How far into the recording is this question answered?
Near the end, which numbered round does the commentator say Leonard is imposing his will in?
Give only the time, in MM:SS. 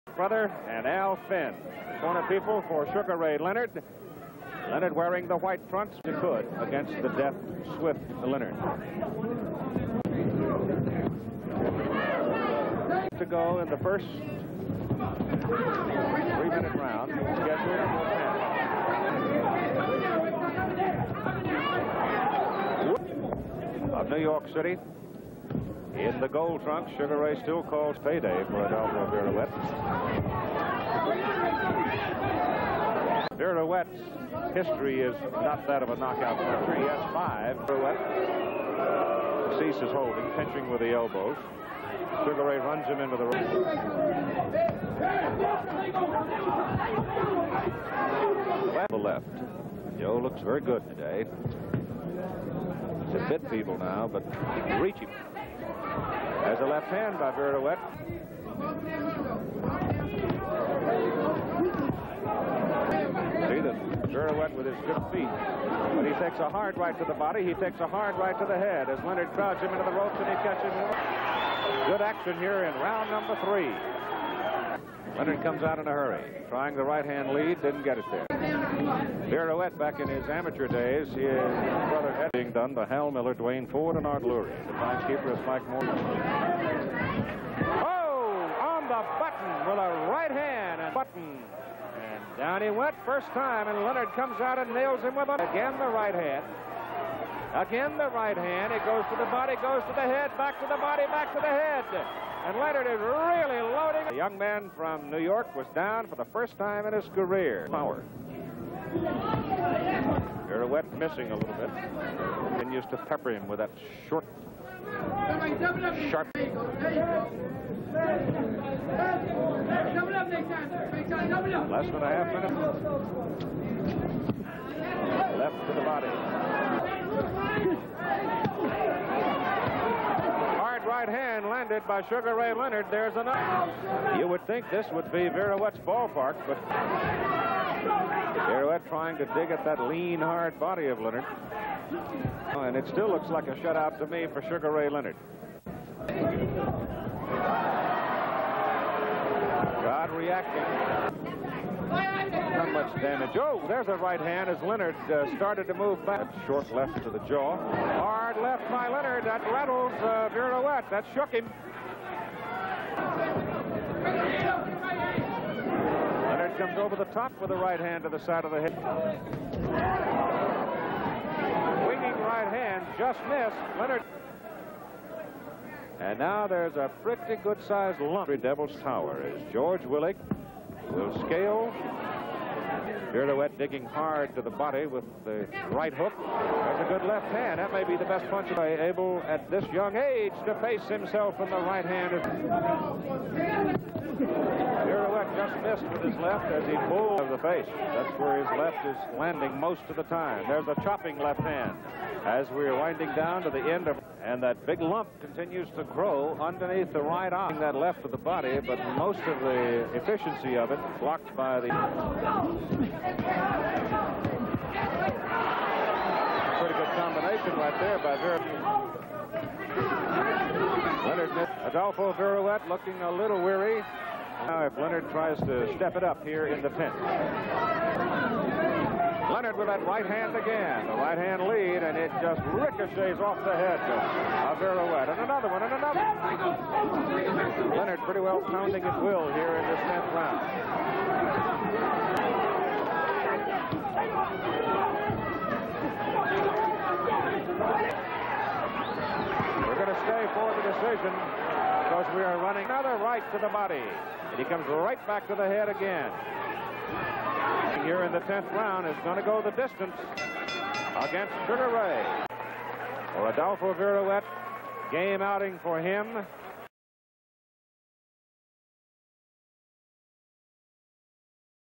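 03:59.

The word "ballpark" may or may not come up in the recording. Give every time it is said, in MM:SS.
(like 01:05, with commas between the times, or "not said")
02:15.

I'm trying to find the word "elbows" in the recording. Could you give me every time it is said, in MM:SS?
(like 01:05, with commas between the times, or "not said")
00:40.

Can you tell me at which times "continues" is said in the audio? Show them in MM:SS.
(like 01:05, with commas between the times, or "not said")
01:52, 03:25.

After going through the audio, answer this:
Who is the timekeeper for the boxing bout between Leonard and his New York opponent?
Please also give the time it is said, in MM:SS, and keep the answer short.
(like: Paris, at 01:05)
Mike Morgan, at 01:25.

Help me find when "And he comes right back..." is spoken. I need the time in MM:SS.
04:14.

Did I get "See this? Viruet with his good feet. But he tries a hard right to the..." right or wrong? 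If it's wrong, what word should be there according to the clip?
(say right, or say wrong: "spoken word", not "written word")
wrong: "takes", not "tries".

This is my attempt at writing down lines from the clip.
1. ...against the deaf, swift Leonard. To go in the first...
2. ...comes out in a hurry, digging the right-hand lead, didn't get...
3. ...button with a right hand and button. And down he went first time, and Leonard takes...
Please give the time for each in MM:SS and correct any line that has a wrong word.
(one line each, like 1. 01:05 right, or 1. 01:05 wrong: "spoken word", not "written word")
1. 00:06 right
2. 01:15 wrong: "trying", not "digging"
3. 01:29 wrong: "comes", not "takes".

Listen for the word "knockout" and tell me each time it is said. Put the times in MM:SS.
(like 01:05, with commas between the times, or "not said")
00:35.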